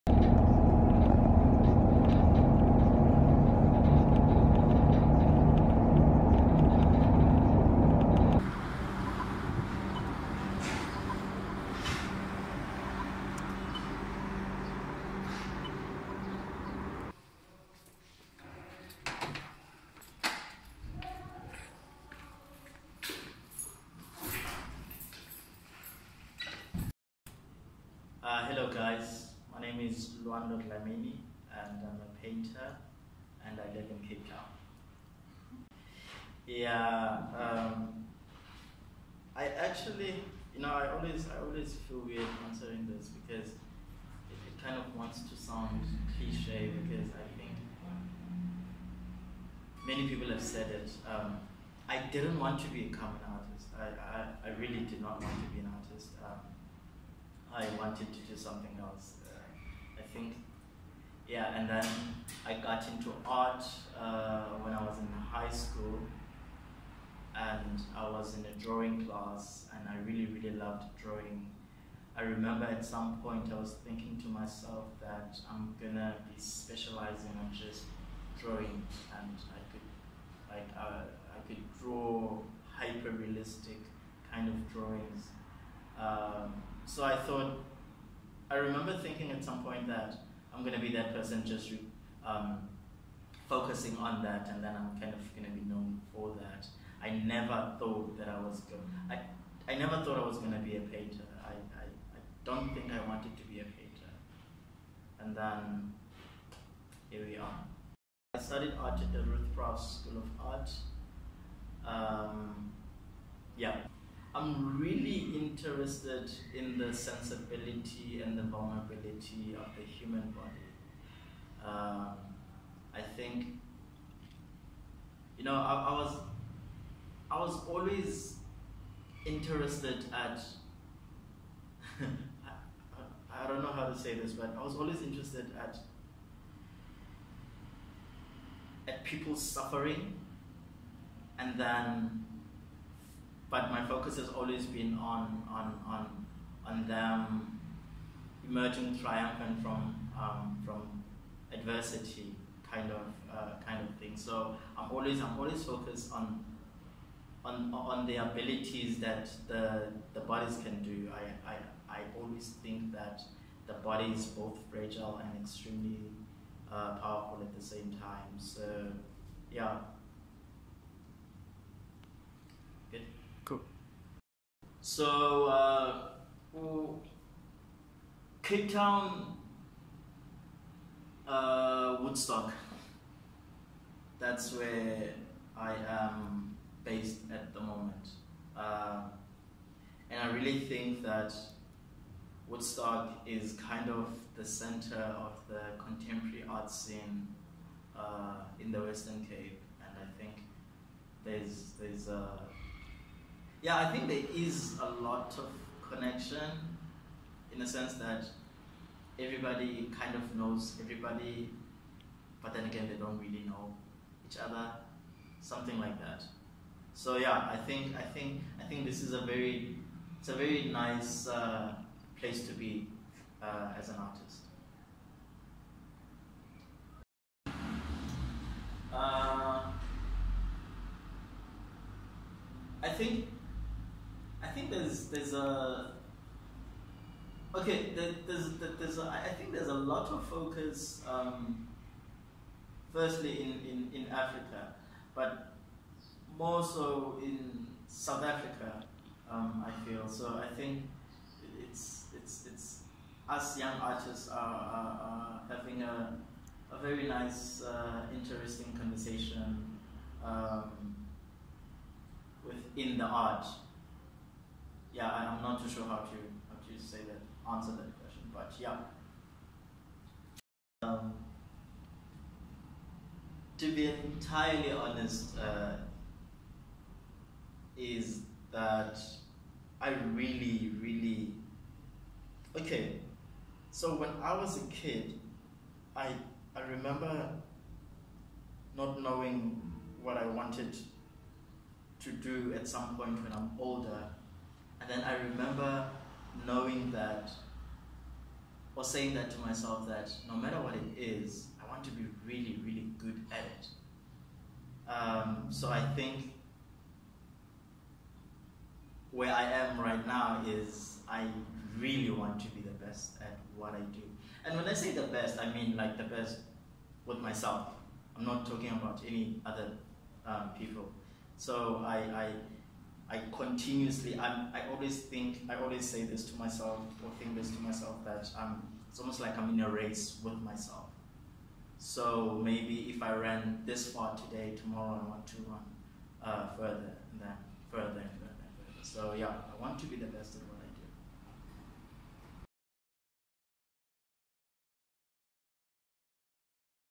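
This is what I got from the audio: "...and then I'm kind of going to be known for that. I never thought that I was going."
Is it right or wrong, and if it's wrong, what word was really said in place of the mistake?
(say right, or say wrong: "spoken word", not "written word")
right.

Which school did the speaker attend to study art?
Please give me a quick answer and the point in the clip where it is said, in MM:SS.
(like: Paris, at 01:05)
Ruth Prowse School of Art, at 01:49.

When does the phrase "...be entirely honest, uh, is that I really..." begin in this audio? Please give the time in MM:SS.
04:33.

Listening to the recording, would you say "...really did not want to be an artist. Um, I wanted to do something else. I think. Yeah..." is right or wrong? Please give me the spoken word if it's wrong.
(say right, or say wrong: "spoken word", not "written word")
right.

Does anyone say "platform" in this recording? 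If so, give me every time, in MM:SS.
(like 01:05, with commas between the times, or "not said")
not said.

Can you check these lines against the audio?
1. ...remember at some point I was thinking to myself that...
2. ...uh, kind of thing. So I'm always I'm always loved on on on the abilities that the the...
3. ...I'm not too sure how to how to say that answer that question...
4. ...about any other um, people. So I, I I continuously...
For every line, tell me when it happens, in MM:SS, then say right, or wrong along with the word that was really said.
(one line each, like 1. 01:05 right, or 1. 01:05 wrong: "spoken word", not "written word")
1. 01:12 right
2. 02:33 wrong: "focused", not "loved"
3. 04:25 right
4. 05:18 right.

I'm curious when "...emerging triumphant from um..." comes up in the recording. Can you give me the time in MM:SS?
02:28.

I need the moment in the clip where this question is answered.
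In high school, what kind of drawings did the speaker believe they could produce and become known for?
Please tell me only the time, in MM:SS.
01:22.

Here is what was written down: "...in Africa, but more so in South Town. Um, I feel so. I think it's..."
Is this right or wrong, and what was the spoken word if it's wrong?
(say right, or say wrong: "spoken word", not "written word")
wrong: "Africa", not "Town".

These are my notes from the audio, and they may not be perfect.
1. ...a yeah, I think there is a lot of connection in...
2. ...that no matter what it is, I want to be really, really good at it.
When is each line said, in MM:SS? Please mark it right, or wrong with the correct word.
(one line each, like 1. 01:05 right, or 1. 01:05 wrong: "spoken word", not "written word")
1. 03:22 right
2. 04:59 right.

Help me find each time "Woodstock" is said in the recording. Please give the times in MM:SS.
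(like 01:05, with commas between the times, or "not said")
03:02, 03:12.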